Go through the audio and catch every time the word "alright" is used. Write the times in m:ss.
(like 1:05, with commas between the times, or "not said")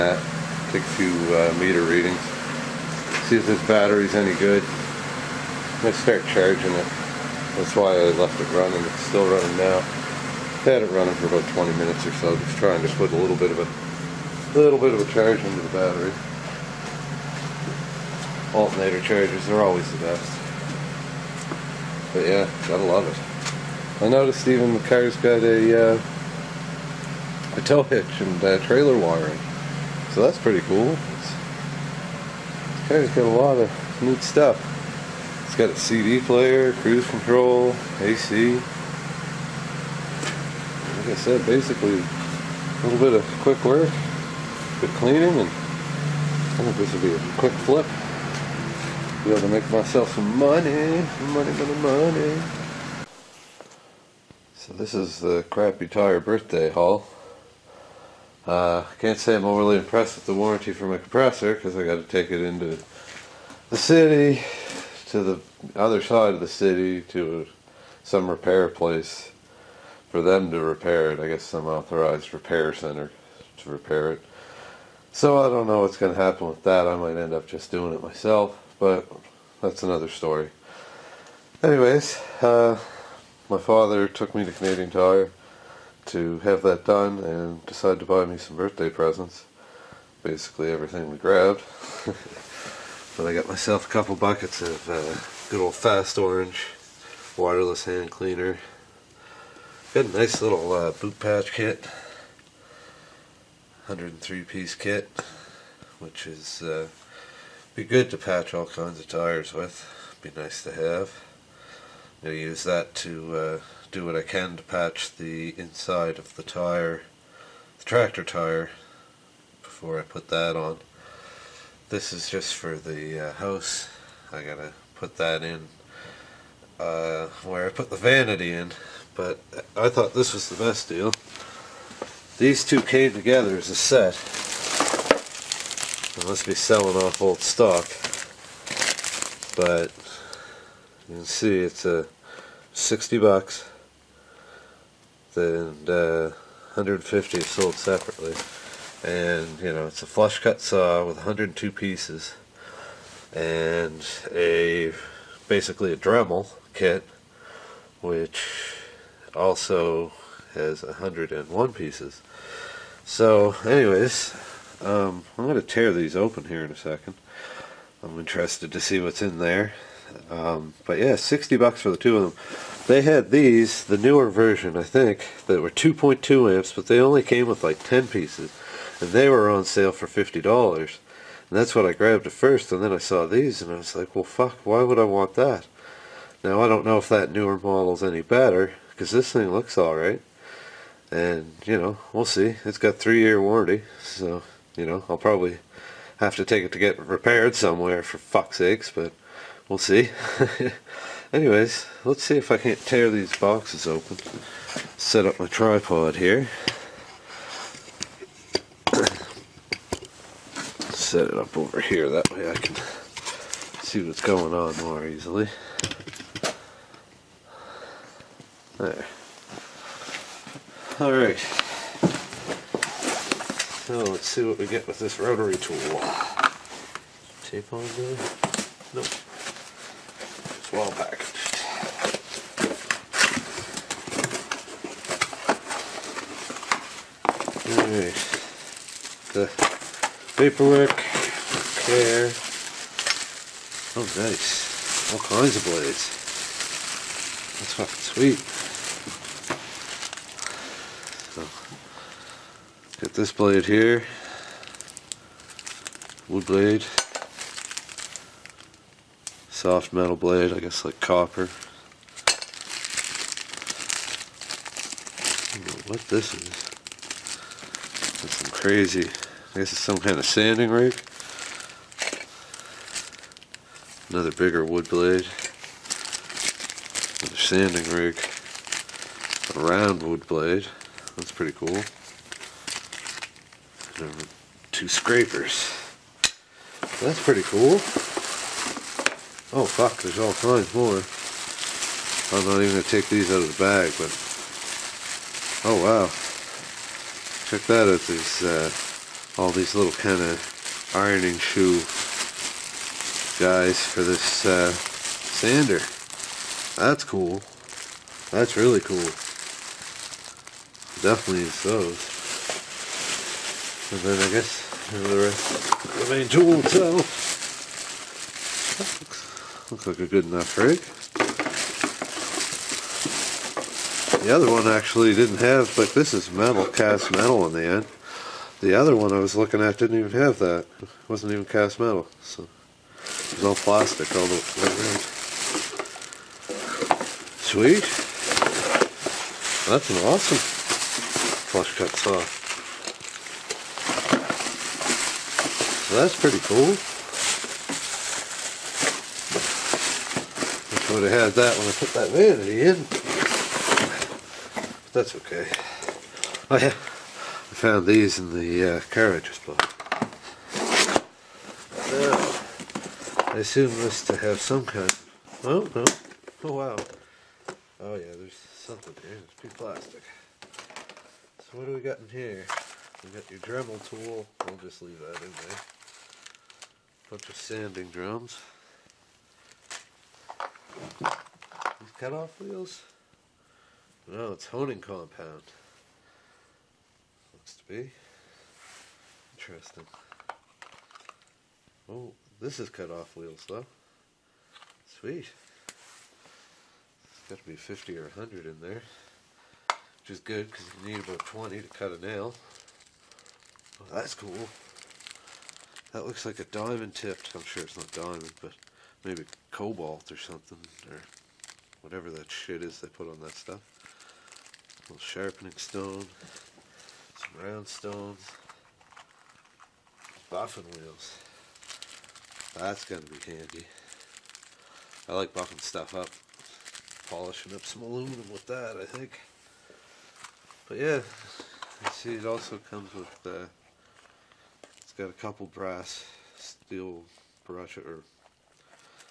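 3:09, 3:41.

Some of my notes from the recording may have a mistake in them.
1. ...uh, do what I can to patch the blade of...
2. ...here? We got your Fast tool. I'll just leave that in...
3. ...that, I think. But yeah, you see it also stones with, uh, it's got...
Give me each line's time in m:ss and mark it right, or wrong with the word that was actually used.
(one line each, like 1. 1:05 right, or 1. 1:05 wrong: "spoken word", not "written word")
1. 1:53 wrong: "inside", not "blade"
2. 6:12 wrong: "Dremel", not "Fast"
3. 7:08 wrong: "comes", not "stones".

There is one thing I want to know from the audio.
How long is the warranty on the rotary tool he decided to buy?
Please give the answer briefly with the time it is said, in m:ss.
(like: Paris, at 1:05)
3 years, at 3:12.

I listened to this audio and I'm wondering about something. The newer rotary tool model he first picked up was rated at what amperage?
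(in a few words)
2.2 amps.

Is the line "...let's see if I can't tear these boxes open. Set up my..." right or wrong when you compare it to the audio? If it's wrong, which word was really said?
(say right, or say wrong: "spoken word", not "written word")
right.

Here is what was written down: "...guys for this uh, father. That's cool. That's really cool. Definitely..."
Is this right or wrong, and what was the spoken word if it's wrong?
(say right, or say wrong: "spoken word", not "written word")
wrong: "sander", not "father".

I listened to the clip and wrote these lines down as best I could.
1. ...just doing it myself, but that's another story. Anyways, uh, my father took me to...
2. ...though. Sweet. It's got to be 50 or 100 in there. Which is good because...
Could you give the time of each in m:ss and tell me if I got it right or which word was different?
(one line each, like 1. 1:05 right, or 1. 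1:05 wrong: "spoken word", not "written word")
1. 1:17 right
2. 6:33 right.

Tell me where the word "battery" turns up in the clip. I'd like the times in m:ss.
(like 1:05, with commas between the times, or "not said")
0:03, 0:15.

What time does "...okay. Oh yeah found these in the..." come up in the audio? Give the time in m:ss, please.
5:55.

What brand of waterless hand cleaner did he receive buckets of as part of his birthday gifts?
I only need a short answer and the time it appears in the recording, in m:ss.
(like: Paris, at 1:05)
Fast Orange, at 1:35.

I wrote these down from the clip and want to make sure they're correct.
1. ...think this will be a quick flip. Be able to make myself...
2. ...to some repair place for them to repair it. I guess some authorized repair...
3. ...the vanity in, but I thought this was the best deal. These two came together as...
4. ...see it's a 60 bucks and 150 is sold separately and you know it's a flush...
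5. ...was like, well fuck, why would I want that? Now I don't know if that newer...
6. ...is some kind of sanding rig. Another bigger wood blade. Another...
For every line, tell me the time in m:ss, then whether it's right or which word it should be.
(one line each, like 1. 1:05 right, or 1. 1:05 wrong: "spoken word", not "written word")
1. 0:46 right
2. 1:07 right
3. 2:07 right
4. 2:21 right
5. 3:03 right
6. 4:29 right.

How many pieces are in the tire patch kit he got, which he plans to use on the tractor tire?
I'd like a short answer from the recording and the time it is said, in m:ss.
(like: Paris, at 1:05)
103, at 1:43.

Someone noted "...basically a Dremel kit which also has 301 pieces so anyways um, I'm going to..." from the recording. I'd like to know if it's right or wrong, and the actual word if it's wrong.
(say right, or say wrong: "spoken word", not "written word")
wrong: "101", not "301".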